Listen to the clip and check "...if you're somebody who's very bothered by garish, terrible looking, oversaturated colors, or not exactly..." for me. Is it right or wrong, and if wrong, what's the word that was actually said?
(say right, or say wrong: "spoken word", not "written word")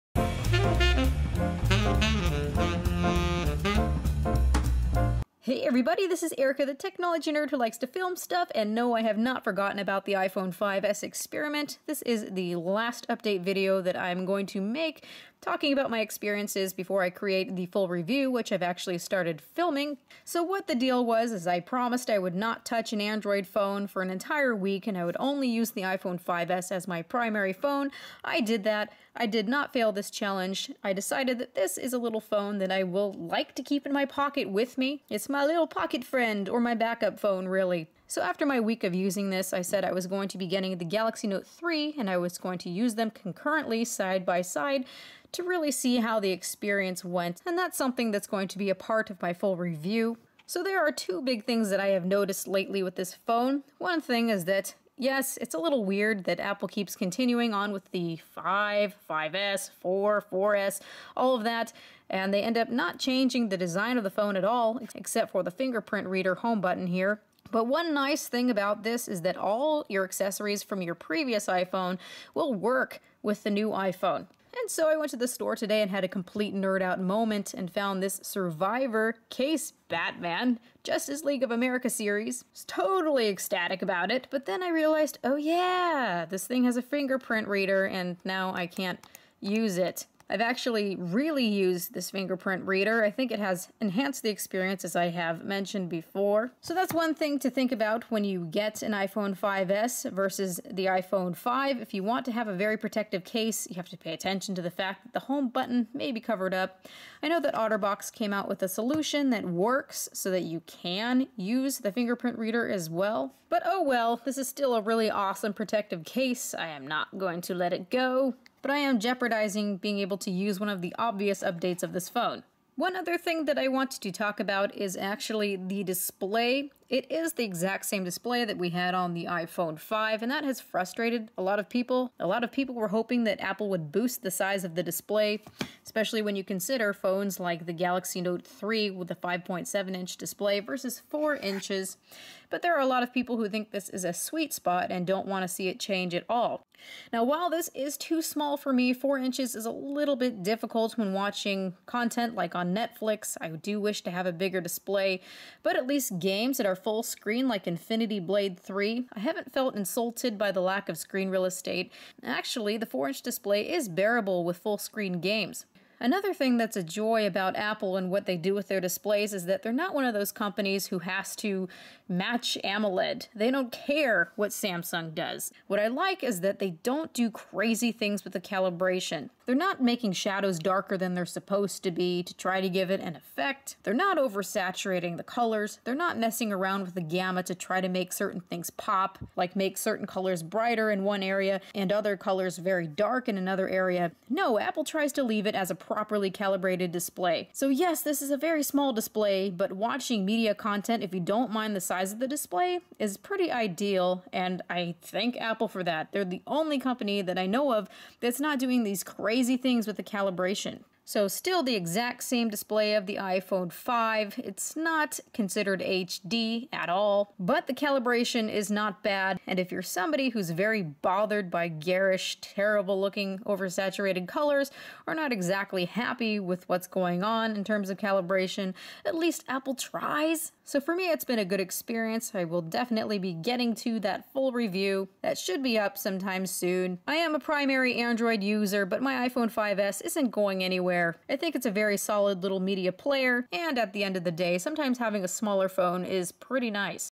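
right.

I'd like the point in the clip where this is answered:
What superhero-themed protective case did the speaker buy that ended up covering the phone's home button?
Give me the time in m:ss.
1:18.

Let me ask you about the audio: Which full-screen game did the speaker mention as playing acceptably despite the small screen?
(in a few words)
Infinity Blade 3.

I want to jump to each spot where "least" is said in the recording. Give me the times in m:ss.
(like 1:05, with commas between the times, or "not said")
2:35, 3:49.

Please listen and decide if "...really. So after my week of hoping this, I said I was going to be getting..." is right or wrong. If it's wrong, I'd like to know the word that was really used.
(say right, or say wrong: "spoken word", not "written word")
wrong: "using", not "hoping".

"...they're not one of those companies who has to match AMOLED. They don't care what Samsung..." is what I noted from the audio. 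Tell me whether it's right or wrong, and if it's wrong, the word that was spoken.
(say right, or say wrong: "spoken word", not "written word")
right.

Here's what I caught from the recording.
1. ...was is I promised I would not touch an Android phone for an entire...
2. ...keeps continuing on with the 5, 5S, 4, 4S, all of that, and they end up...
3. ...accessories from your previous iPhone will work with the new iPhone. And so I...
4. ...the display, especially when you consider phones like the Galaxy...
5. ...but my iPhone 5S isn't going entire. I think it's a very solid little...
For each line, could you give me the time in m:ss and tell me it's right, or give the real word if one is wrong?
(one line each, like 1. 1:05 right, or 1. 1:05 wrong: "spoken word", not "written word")
1. 0:21 right
2. 0:56 right
3. 1:10 right
4. 2:14 right
5. 3:58 wrong: "anywhere", not "entire".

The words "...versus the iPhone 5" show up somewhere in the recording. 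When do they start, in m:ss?
1:40.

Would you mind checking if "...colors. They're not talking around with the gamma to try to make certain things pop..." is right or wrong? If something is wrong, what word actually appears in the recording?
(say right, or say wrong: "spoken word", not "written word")
wrong: "messing", not "talking".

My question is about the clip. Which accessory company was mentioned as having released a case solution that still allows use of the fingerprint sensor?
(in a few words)
OtterBox.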